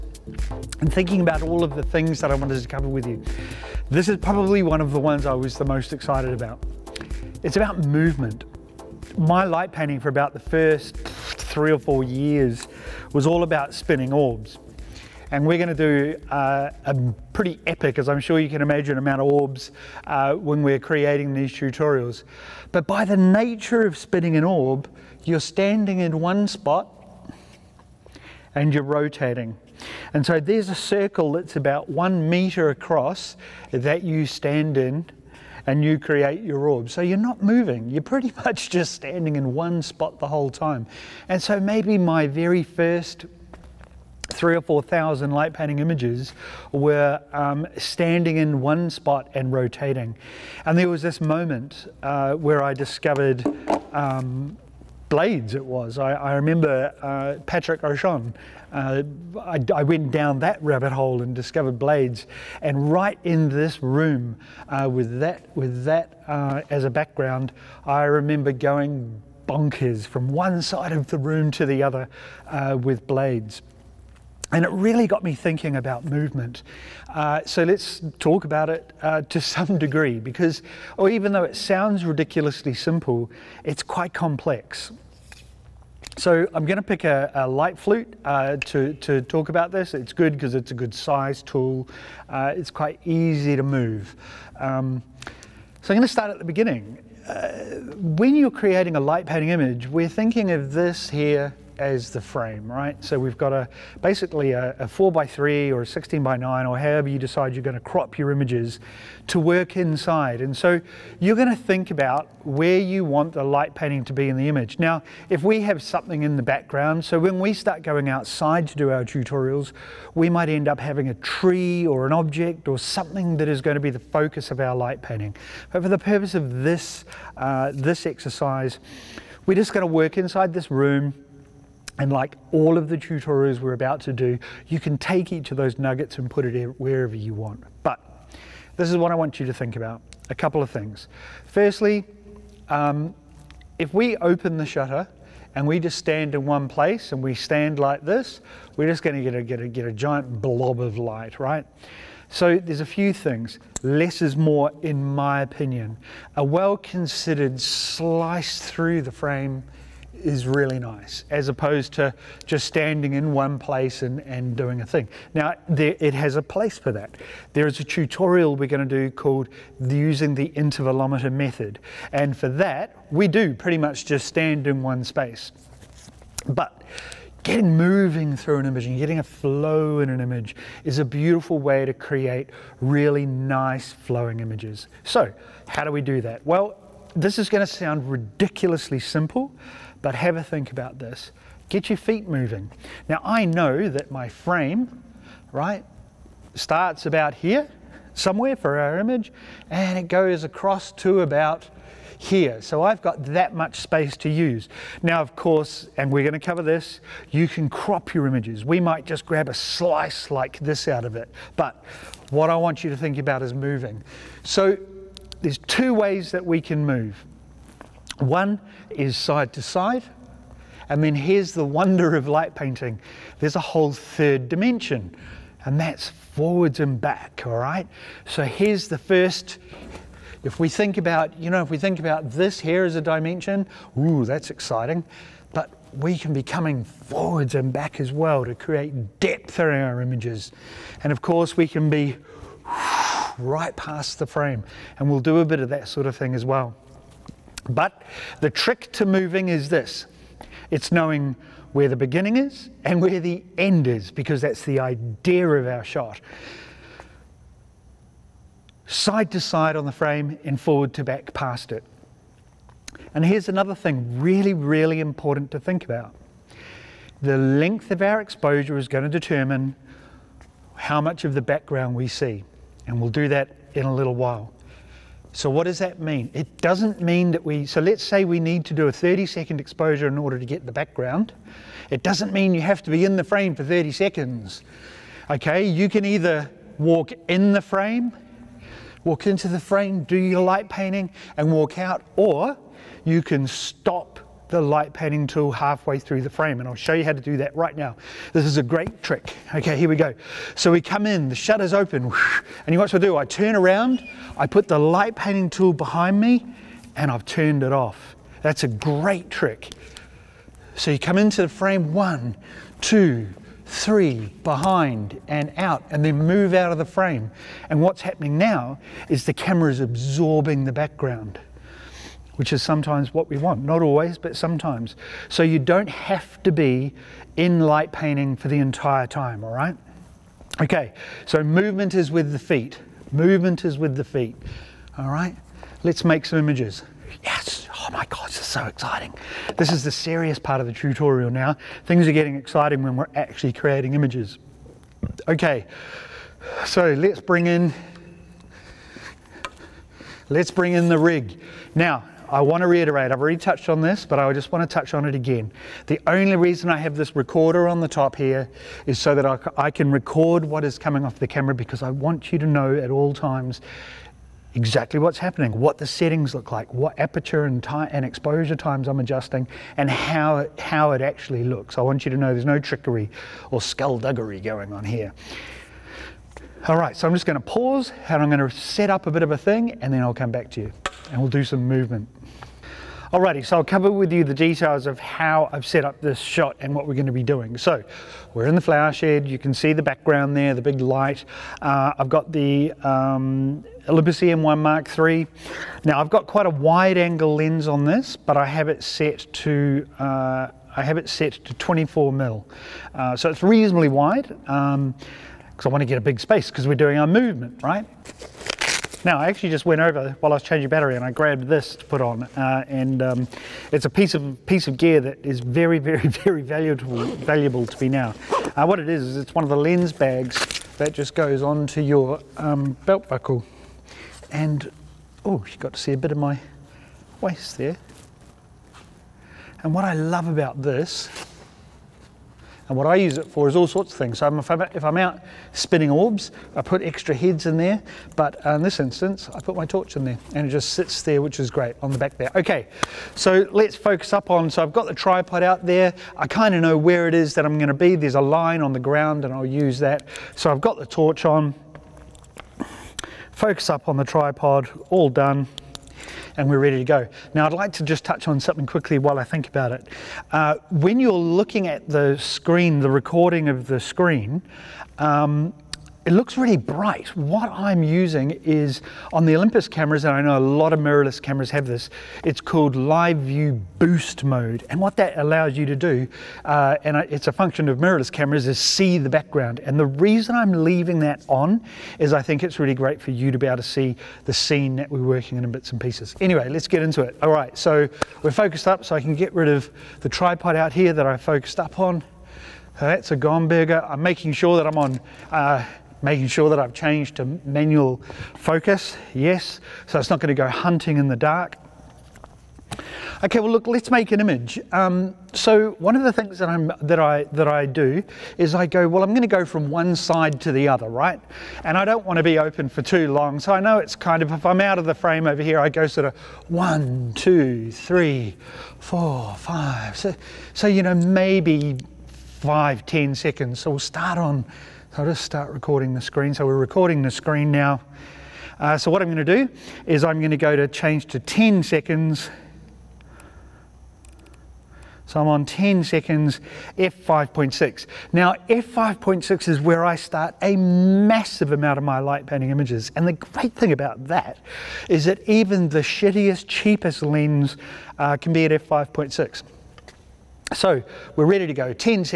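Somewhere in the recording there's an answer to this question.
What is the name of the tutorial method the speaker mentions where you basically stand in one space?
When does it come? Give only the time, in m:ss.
2:50.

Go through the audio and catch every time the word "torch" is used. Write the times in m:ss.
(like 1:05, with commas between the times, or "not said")
7:19, 7:30.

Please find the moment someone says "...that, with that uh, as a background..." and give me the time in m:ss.
1:05.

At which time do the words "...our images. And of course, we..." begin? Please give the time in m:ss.
3:59.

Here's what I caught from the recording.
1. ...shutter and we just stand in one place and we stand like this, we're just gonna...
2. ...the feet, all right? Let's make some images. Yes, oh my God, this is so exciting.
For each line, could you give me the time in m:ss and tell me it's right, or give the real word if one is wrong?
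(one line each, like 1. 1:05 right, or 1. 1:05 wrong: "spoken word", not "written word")
1. 2:24 right
2. 5:33 right.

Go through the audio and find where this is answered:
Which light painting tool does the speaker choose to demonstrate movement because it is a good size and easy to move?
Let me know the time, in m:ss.
1:27.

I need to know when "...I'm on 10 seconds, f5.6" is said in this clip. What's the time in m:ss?
8:55.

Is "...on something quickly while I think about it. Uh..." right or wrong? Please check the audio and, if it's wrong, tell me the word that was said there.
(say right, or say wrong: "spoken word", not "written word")
right.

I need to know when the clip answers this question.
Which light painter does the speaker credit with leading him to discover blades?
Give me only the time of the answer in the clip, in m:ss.
0:57.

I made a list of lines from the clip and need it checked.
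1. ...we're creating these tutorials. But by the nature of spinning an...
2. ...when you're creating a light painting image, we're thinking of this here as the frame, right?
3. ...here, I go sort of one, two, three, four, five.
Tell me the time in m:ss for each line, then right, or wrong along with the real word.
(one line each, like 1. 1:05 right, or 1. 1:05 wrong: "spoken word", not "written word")
1. 0:20 right
2. 1:37 right
3. 8:35 right.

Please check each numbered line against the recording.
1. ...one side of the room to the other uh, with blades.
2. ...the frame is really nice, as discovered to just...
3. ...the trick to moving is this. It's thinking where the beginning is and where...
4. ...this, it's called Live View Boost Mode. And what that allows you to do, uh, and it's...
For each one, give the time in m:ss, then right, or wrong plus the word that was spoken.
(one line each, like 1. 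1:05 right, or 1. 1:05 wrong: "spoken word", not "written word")
1. 1:10 right
2. 2:39 wrong: "opposed", not "discovered"
3. 4:08 wrong: "knowing", not "thinking"
4. 7:51 right.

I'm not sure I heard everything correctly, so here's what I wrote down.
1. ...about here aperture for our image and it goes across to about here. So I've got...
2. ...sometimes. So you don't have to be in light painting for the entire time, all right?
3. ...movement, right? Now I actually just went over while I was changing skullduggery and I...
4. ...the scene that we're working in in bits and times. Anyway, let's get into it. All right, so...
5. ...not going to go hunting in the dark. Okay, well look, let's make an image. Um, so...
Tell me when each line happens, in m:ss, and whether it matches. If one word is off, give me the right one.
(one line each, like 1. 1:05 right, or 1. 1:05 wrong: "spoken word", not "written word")
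1. 3:17 wrong: "somewhere", not "aperture"
2. 5:24 right
3. 6:47 wrong: "battery", not "skullduggery"
4. 8:04 wrong: "pieces", not "times"
5. 8:20 right.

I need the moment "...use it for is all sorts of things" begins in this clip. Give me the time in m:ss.
7:12.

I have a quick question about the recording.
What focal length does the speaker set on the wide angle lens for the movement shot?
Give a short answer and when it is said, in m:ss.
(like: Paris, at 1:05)
24mm, at 6:41.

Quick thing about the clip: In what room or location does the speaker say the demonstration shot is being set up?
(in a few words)
The flower shed.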